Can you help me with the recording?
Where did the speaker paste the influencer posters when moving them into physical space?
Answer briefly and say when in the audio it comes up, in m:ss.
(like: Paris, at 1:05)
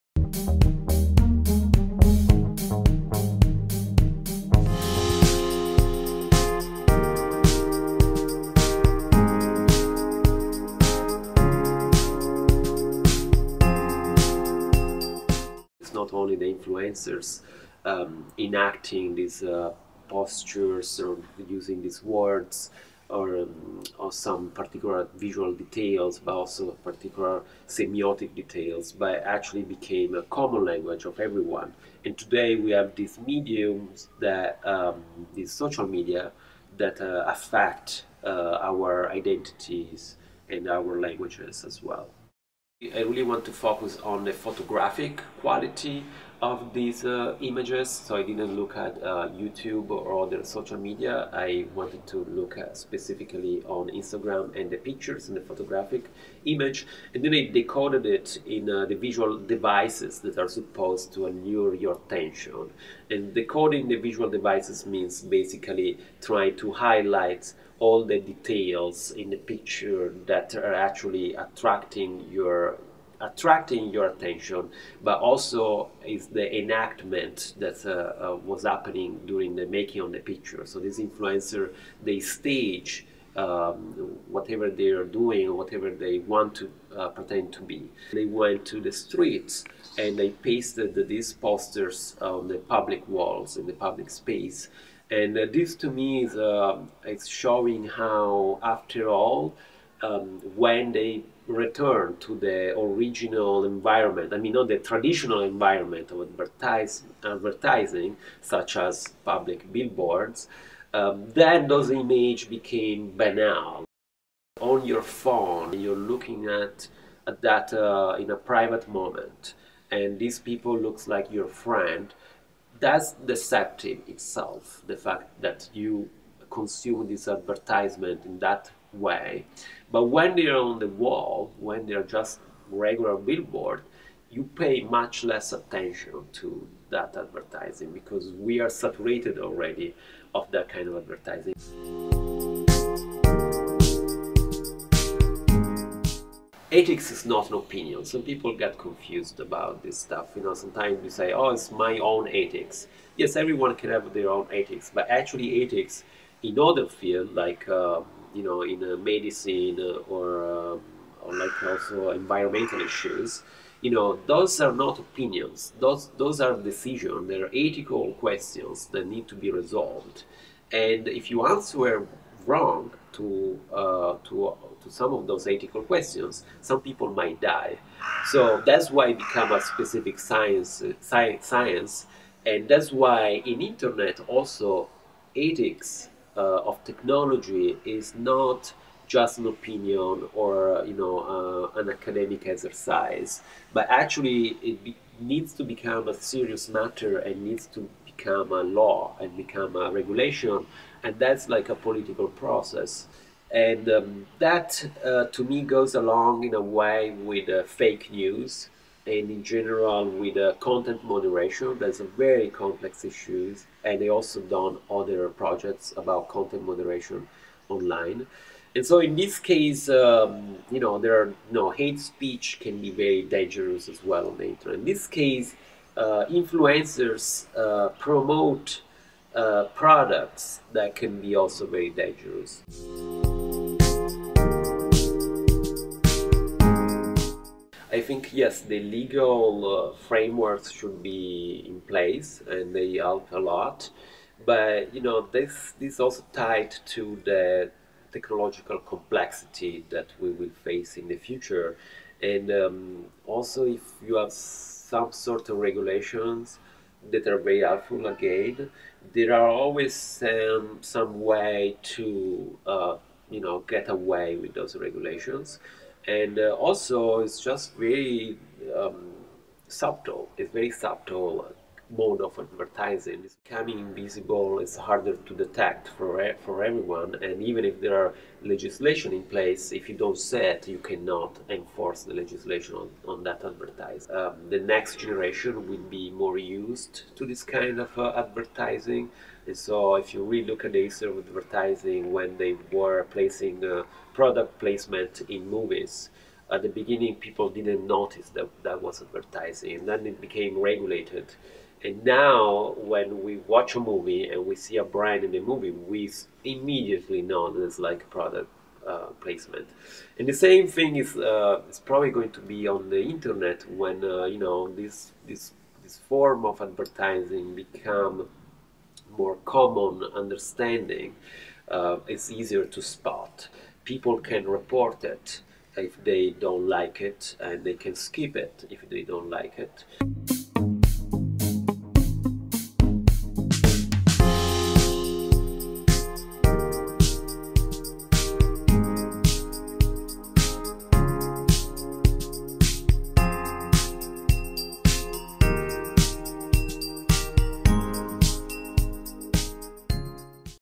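public walls, at 1:32.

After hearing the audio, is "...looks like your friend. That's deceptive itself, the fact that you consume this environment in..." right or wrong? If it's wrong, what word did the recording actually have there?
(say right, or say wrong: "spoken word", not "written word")
wrong: "advertisement", not "environment".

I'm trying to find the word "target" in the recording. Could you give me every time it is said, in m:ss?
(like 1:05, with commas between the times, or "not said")
not said.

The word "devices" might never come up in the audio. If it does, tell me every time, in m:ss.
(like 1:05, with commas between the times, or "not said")
0:59, 1:04.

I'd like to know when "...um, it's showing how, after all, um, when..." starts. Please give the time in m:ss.
1:36.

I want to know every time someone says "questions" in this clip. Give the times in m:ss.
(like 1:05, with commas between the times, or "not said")
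2:48, 2:55.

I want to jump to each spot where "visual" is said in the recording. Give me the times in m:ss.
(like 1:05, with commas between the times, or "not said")
0:25, 0:58, 1:03.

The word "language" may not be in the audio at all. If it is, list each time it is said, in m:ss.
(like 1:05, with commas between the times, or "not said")
0:30, 0:41.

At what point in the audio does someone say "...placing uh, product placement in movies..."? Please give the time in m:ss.
4:53.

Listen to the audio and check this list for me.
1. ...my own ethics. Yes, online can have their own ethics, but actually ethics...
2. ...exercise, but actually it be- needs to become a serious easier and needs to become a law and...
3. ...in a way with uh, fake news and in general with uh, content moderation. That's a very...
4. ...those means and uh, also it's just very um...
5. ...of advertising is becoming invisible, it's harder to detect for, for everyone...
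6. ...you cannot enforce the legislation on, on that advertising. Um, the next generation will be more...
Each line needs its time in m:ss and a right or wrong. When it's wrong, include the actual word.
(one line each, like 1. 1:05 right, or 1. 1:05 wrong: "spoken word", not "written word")
1. 2:31 wrong: "everyone", not "online"
2. 3:12 wrong: "matter", not "easier"
3. 3:26 right
4. 4:24 wrong: "regulations", not "means"
5. 4:32 right
6. 4:40 right.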